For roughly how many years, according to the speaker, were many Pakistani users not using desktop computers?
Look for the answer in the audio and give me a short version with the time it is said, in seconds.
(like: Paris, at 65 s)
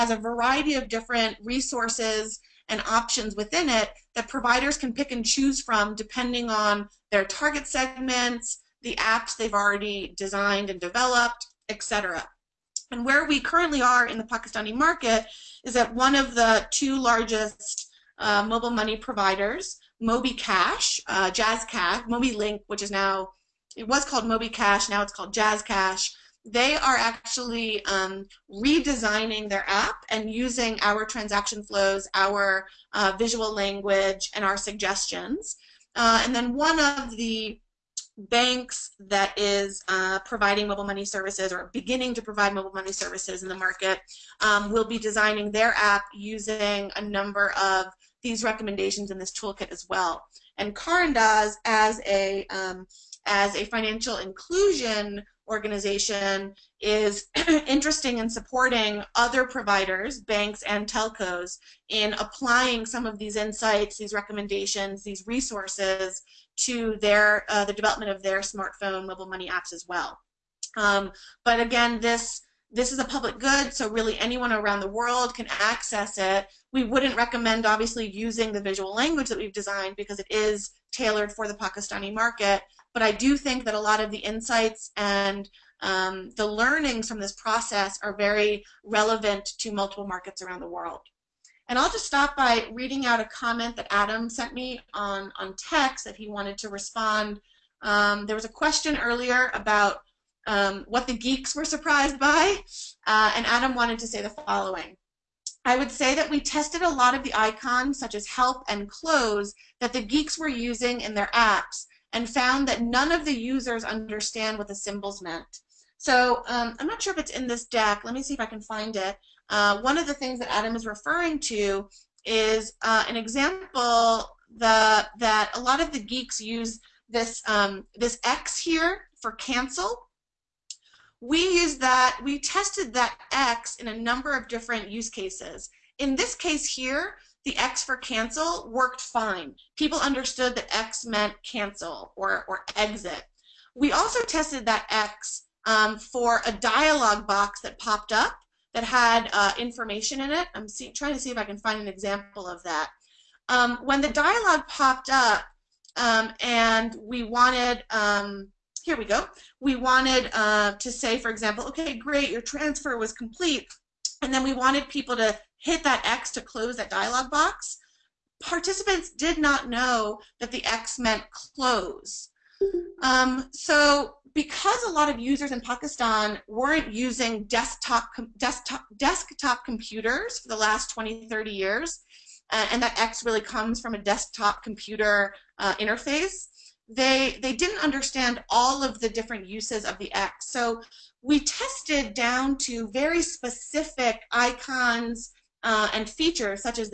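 20 to 30 years, at 180 s.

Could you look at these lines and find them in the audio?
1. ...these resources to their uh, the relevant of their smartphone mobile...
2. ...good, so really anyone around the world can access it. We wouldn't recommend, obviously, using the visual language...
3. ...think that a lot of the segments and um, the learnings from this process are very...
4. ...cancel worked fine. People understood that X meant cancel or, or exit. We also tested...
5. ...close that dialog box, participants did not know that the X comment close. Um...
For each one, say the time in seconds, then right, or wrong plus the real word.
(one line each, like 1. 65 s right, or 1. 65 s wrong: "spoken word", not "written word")
1. 65 s wrong: "development", not "relevant"
2. 73 s right
3. 83 s wrong: "insights", not "segments"
4. 137 s right
5. 166 s wrong: "meant", not "comment".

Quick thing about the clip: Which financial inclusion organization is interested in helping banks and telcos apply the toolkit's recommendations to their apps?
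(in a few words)
Karandaaz.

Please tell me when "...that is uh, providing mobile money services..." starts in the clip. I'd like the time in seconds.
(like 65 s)
38 s.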